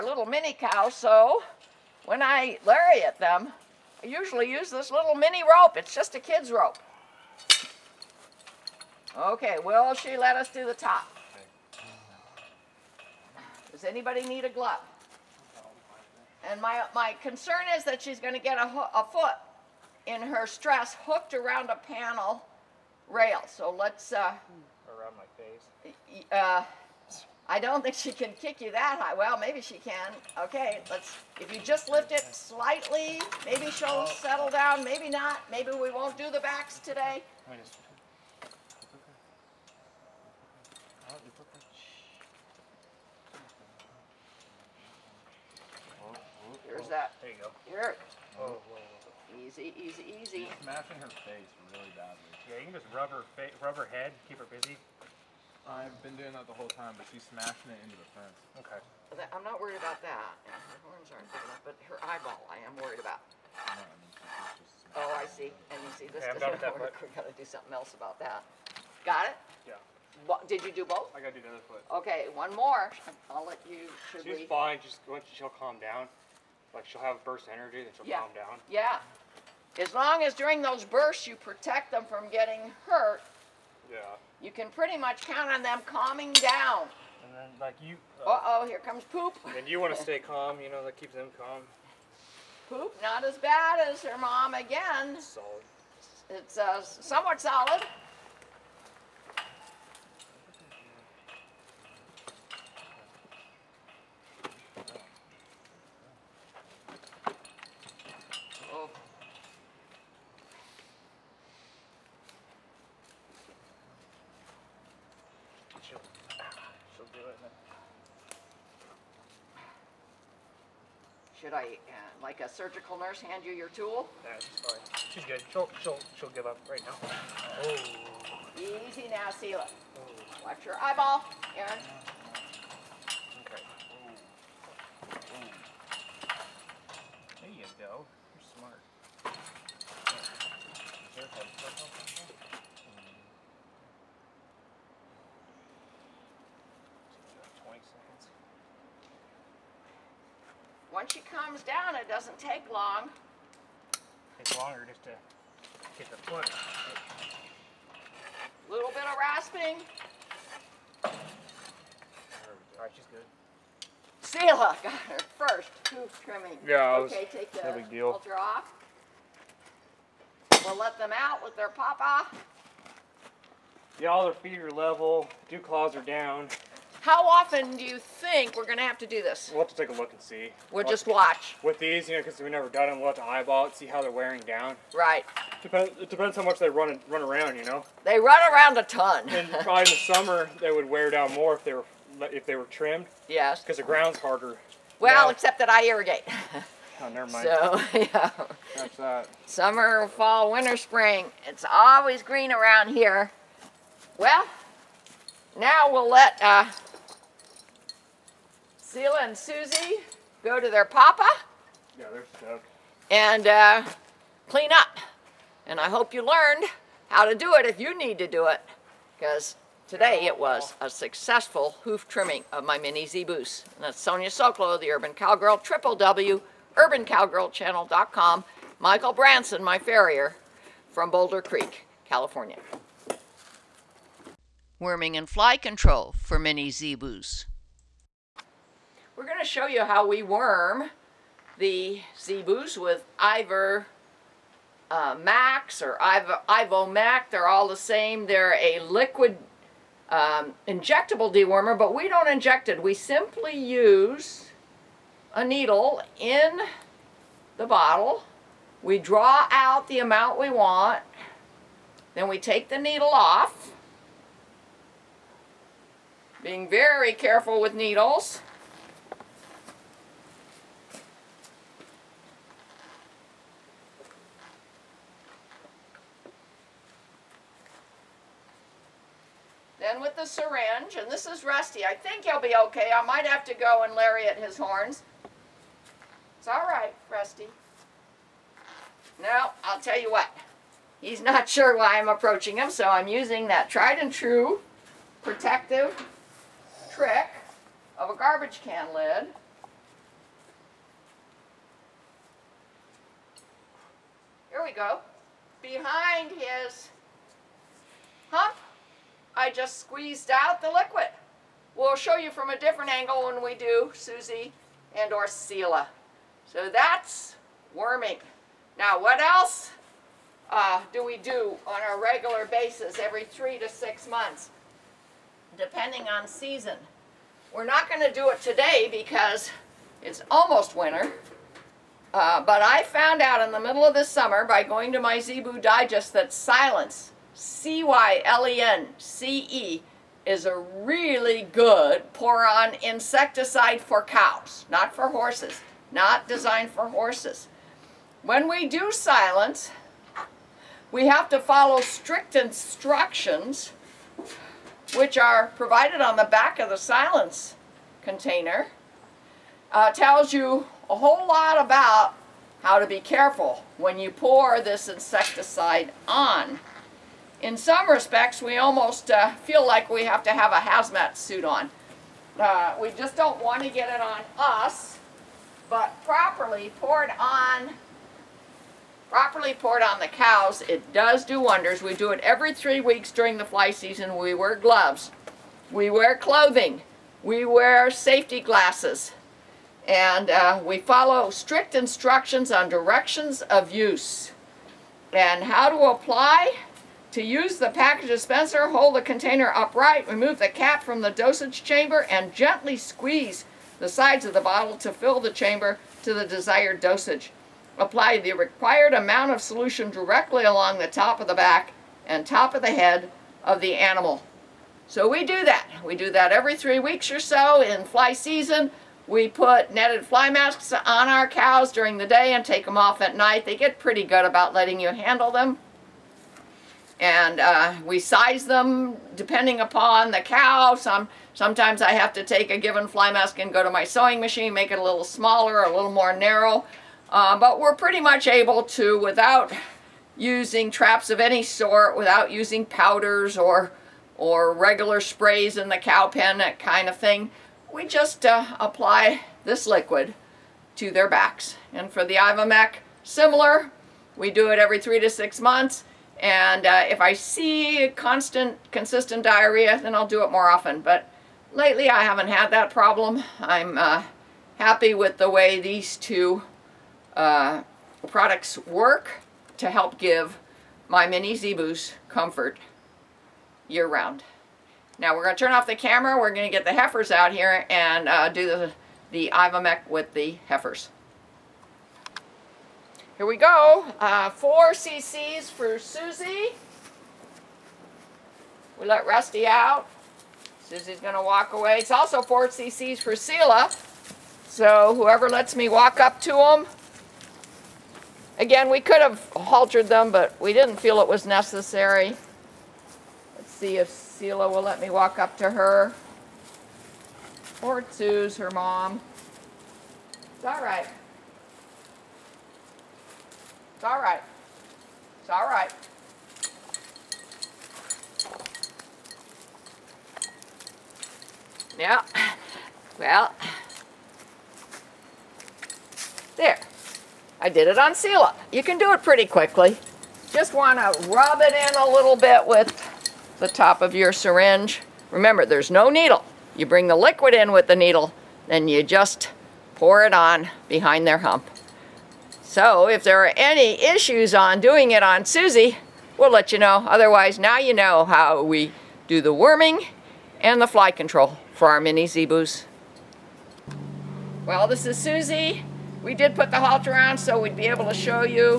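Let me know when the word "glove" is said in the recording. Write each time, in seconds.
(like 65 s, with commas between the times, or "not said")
14 s, 384 s.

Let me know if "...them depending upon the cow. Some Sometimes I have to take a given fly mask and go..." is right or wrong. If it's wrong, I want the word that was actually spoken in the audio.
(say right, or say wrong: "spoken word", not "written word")
right.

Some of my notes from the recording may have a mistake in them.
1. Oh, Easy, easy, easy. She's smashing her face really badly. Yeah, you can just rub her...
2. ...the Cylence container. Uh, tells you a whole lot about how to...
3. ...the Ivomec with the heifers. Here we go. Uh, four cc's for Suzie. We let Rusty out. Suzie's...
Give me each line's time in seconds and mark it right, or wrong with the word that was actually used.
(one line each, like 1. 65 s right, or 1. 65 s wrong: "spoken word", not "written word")
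1. 48 s right
2. 356 s right
3. 479 s right.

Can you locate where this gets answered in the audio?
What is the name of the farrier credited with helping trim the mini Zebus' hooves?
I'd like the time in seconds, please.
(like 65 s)
228 s.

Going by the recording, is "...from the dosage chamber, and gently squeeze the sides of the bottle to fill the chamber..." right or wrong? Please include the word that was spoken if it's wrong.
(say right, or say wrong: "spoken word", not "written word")
right.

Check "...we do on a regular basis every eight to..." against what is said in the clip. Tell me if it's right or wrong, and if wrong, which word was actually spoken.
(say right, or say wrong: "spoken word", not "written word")
wrong: "three", not "eight".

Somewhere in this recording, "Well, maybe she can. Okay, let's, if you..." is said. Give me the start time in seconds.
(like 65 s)
29 s.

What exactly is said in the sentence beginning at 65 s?
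And you see, this okay, doesn't work.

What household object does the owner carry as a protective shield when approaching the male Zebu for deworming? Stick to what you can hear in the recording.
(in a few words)
Garbage can lid.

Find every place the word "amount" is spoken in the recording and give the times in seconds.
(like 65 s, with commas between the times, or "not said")
259 s, 408 s.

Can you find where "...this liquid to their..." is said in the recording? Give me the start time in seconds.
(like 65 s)
449 s.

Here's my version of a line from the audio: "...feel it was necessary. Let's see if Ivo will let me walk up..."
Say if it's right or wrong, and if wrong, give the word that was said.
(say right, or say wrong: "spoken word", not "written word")
wrong: "Seela", not "Ivo".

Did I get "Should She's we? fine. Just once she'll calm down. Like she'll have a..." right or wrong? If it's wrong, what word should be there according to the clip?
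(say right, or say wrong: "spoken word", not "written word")
right.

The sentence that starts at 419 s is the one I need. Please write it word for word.
We put netted fly masks on our cows during the day and take them off at night.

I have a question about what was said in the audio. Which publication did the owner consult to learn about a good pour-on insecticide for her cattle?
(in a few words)
Zebu Digest.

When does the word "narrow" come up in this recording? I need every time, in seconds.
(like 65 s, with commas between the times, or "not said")
436 s.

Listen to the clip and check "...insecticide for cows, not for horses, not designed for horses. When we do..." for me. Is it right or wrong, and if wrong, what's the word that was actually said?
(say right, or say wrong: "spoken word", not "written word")
right.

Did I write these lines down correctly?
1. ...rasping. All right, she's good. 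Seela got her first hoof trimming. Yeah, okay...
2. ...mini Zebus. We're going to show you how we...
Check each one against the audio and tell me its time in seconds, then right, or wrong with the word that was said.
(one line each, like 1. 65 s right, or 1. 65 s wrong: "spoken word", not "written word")
1. 159 s right
2. 236 s right.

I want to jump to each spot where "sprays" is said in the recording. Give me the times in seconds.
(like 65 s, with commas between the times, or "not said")
445 s.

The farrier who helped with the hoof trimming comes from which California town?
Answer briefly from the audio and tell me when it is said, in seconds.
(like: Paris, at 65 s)
Boulder Creek, at 231 s.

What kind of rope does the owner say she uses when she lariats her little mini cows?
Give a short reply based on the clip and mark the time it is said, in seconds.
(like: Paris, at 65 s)
A kid's rope, at 6 s.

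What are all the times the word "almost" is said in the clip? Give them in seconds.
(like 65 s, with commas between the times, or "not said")
330 s, 368 s.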